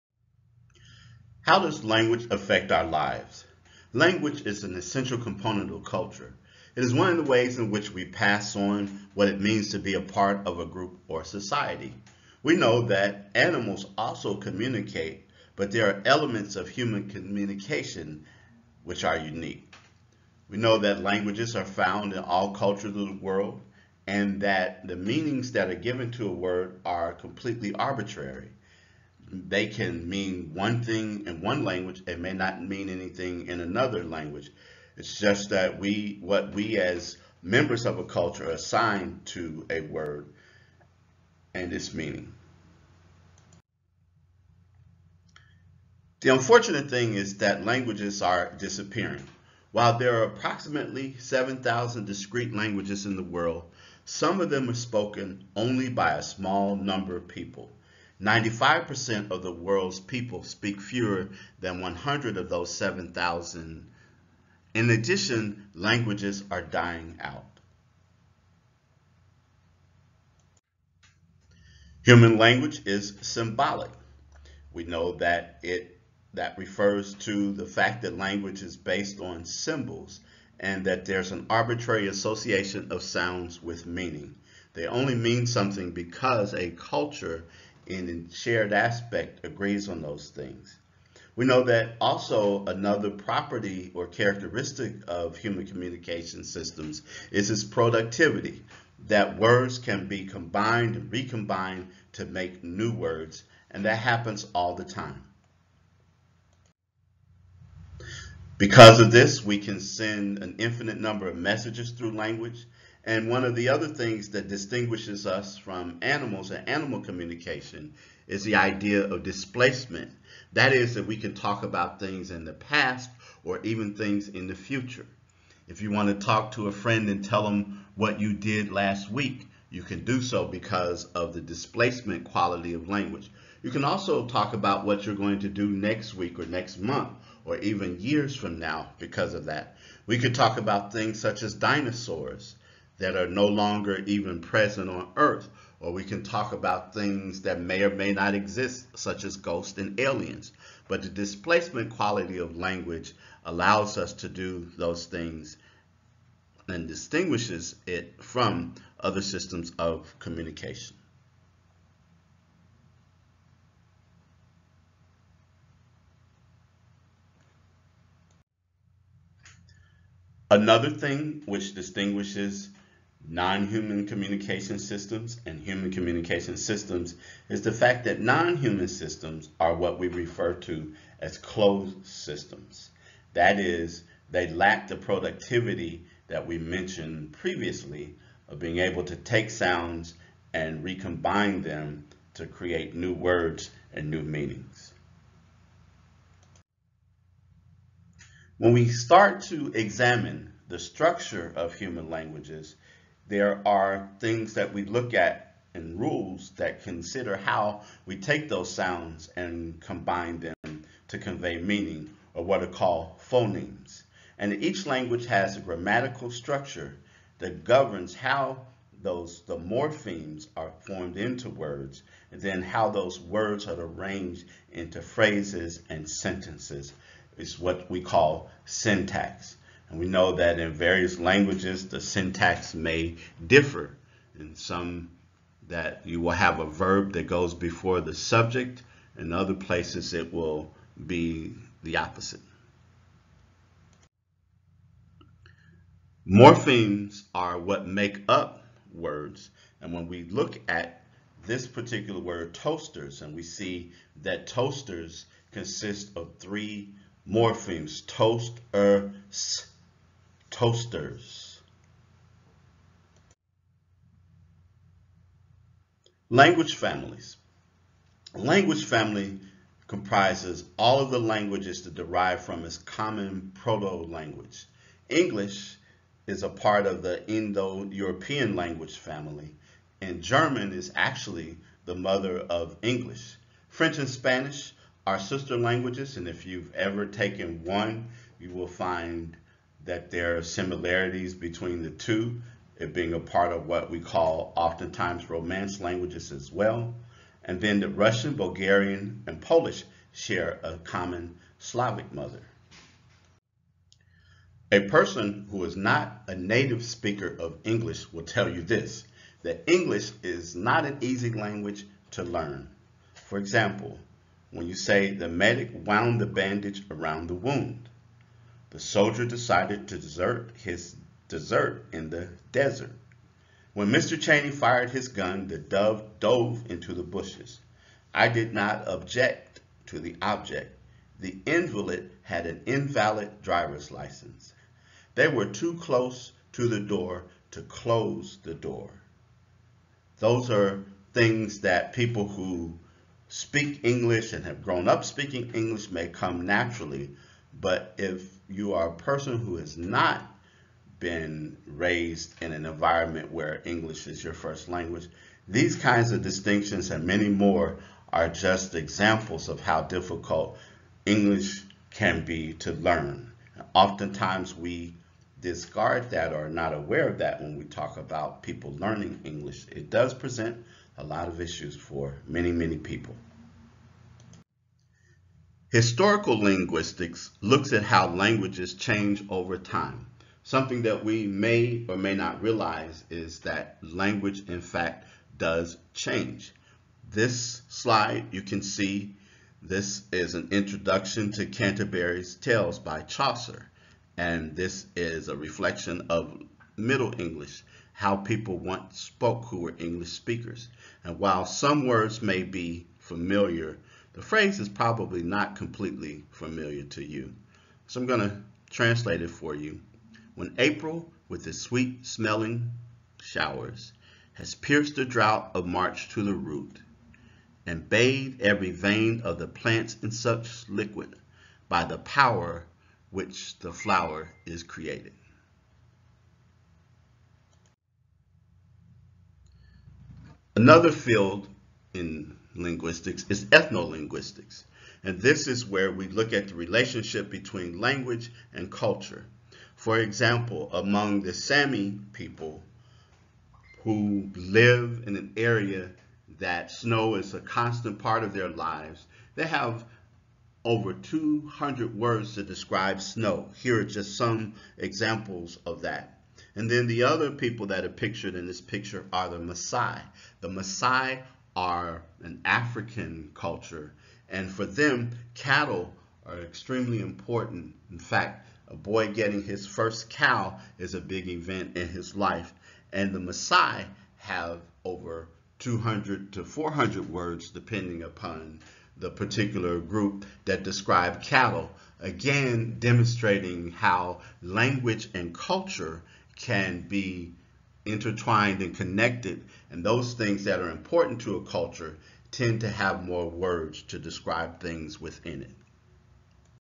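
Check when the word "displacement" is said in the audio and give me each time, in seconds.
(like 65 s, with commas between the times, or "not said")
119 s, 131 s, 151 s.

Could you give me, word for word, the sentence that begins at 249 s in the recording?
And when we look at this particular word, toasters, and we see that toasters consist of three morphemes, toast, er, s, toasters.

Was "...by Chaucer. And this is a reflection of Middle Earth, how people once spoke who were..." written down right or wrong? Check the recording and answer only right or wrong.
wrong.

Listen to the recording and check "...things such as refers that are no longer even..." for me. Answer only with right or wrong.
wrong.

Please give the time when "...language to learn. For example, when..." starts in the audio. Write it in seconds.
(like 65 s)
311 s.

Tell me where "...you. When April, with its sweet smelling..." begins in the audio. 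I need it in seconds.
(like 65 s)
409 s.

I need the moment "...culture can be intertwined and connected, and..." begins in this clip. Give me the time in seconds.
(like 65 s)
485 s.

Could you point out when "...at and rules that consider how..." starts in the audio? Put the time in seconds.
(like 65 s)
205 s.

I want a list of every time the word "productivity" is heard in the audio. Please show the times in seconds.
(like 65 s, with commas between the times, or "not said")
97 s, 184 s.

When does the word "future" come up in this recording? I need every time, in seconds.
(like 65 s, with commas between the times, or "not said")
124 s.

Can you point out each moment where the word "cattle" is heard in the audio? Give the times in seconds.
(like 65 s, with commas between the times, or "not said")
465 s, 481 s.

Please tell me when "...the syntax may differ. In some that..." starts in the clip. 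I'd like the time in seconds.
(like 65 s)
231 s.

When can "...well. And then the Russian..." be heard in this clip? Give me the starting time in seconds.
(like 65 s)
296 s.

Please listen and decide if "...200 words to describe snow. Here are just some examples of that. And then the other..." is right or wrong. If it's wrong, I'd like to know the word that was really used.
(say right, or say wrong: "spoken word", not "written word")
right.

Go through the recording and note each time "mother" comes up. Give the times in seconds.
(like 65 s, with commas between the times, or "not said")
281 s, 302 s.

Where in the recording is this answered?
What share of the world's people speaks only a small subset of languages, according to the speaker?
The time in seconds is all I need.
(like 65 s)
58 s.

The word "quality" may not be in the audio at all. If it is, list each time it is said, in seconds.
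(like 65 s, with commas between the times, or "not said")
132 s, 151 s.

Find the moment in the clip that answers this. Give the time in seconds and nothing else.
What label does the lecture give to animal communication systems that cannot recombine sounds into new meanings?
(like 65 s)
181 s.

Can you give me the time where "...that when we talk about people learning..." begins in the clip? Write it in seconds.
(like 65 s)
367 s.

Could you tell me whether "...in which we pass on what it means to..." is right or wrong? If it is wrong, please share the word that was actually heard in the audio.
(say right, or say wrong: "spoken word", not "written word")
right.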